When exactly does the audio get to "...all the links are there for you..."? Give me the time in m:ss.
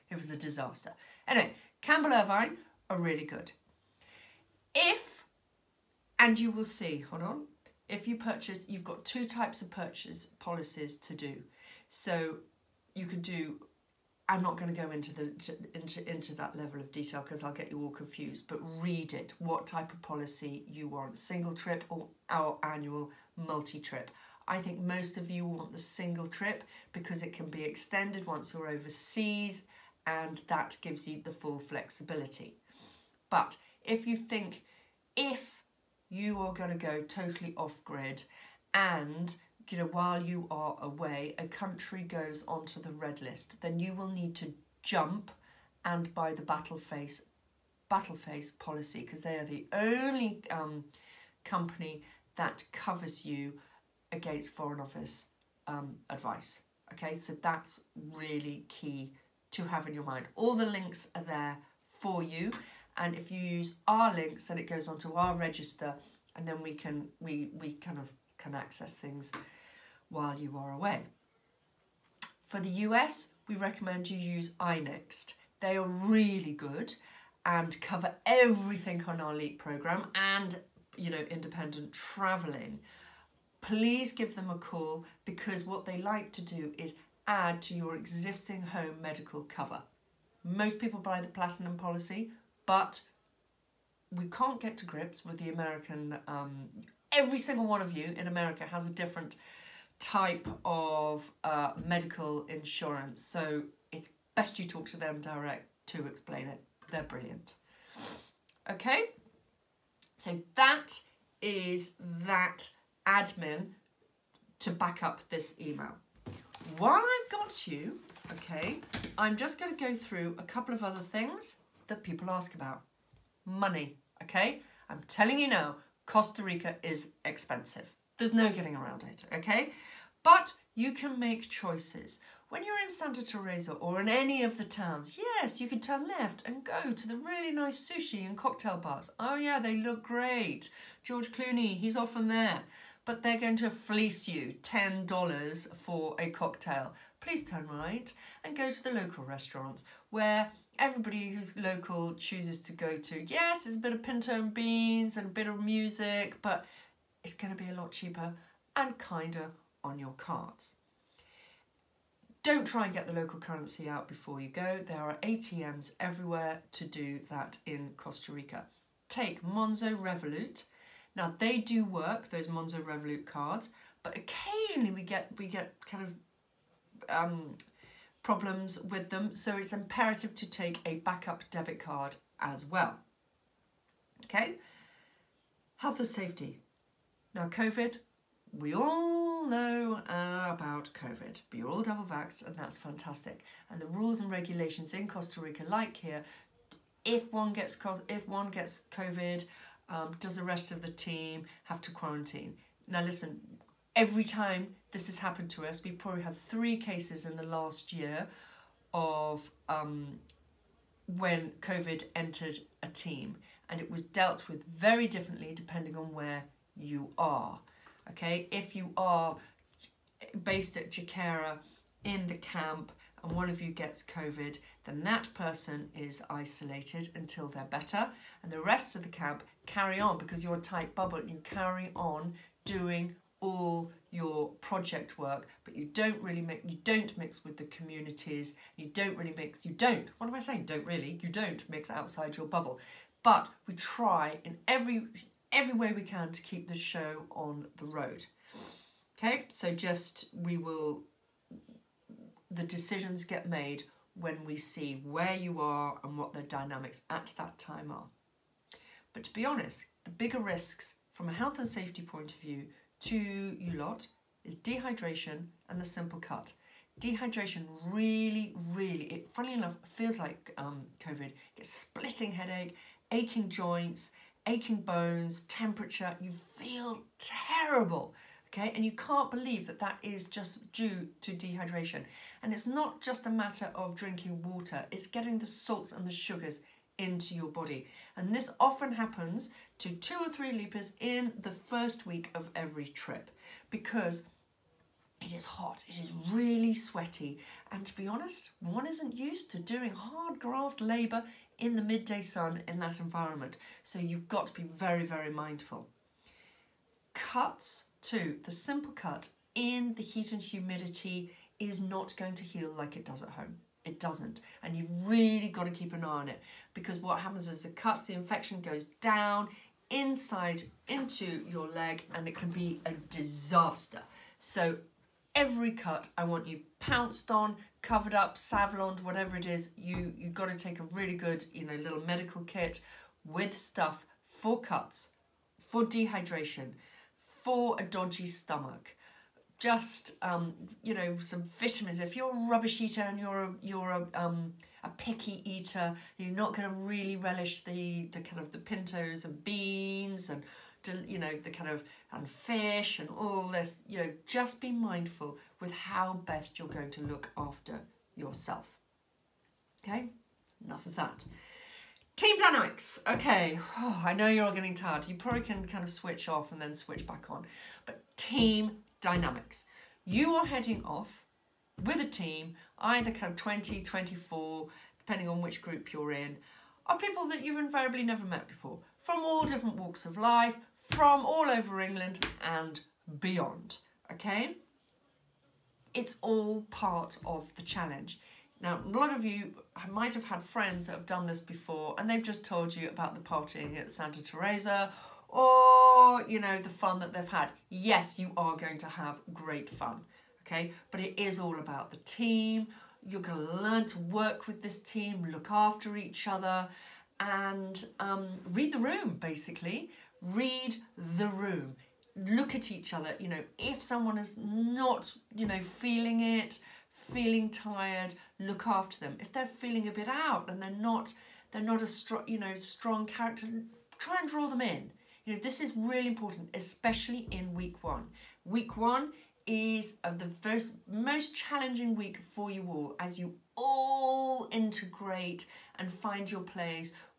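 1:00.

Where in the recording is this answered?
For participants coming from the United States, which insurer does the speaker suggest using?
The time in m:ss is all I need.
1:14.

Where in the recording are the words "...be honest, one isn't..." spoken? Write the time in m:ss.
4:57.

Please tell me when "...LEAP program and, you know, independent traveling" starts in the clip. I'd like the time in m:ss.
1:19.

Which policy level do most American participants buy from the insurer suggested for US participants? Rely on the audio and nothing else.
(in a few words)
Platinum.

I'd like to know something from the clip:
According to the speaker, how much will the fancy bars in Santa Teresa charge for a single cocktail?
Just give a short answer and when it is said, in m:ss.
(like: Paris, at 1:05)
$10, at 2:24.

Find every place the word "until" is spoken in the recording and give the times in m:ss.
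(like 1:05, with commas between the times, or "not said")
3:47.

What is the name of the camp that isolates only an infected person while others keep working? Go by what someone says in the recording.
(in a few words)
Jakera.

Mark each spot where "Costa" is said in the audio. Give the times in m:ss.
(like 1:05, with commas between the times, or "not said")
2:06, 2:47, 3:15.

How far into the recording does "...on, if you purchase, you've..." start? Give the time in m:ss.
0:07.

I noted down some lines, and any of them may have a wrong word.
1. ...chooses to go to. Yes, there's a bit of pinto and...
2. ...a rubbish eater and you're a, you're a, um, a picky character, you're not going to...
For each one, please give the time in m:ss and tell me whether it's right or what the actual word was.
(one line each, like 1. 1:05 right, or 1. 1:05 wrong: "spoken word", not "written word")
1. 2:32 right
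2. 5:42 wrong: "eater", not "character".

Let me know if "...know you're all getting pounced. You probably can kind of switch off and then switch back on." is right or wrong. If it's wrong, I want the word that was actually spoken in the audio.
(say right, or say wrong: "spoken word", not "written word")
wrong: "tired", not "pounced".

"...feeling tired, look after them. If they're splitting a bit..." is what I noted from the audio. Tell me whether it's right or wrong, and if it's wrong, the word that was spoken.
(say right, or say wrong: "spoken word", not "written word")
wrong: "feeling", not "splitting".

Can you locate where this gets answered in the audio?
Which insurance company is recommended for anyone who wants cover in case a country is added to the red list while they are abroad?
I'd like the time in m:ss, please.
0:46.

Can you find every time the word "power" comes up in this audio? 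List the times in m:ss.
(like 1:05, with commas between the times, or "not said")
not said.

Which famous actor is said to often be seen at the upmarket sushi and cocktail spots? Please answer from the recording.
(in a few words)
George Clooney.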